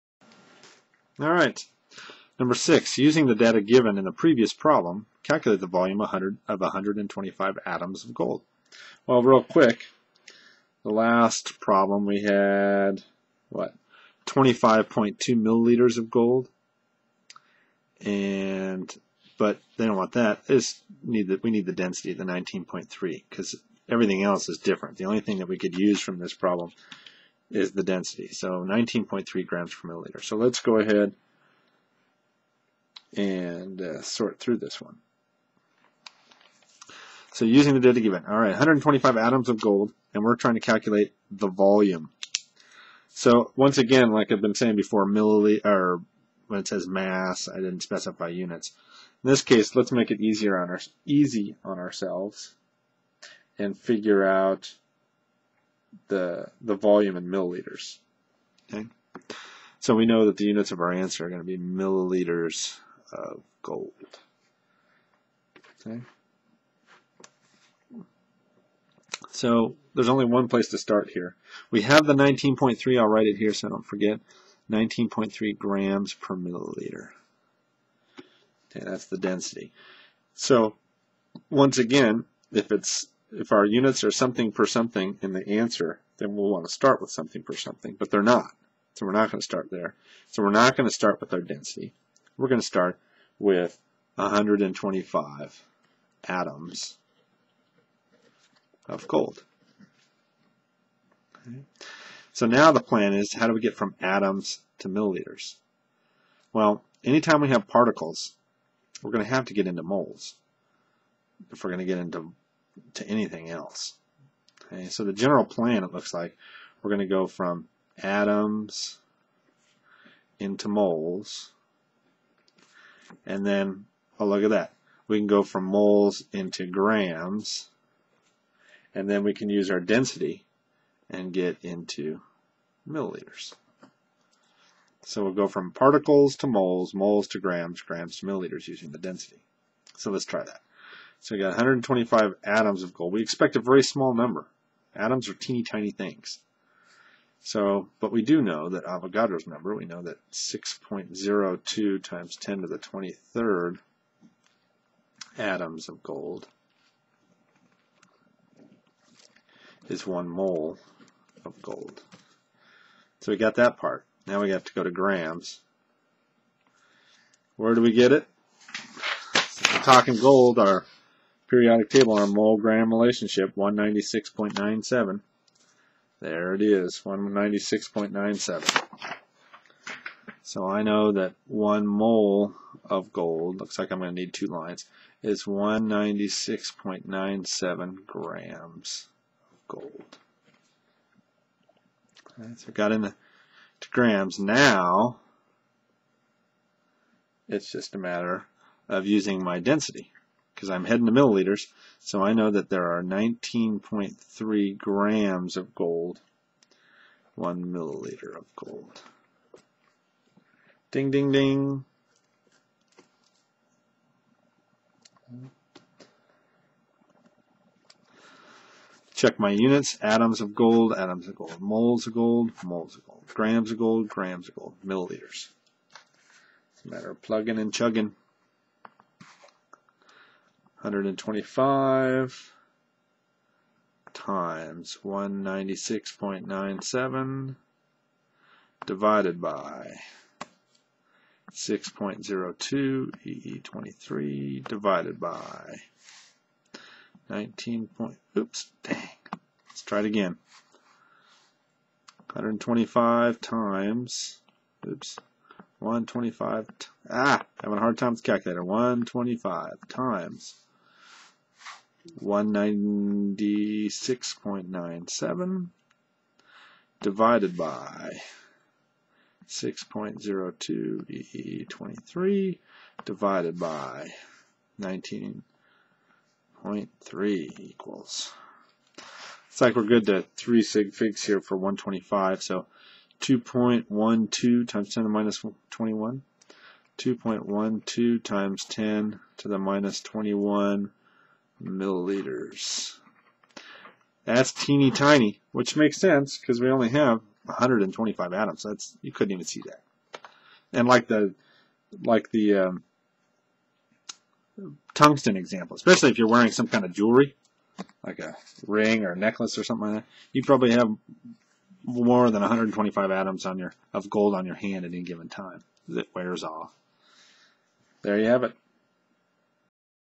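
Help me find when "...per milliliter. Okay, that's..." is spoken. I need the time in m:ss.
1:16.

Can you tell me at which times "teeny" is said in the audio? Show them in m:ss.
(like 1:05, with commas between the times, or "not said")
2:25, 4:54.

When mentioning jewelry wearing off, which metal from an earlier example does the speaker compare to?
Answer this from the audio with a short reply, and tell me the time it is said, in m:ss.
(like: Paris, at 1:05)
tungsten, at 5:04.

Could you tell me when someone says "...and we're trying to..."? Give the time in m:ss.
0:40.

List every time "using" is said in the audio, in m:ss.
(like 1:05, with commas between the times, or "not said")
0:02, 0:37, 2:18, 3:19.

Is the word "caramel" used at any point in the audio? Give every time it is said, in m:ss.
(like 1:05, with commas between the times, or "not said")
not said.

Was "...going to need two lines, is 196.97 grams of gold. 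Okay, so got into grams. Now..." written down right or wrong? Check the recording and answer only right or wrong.
right.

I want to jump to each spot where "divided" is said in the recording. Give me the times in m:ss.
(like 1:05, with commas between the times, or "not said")
3:58, 4:04.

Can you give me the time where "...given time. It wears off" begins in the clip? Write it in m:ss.
5:15.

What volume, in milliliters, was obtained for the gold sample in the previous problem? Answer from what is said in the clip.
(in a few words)
25.2 milliliters.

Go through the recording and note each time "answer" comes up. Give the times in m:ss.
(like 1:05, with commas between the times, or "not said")
1:00, 1:25.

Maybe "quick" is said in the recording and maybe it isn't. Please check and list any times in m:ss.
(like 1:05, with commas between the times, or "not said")
0:09.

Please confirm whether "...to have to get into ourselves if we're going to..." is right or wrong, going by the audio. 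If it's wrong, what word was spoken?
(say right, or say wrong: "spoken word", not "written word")
wrong: "moles", not "ourselves".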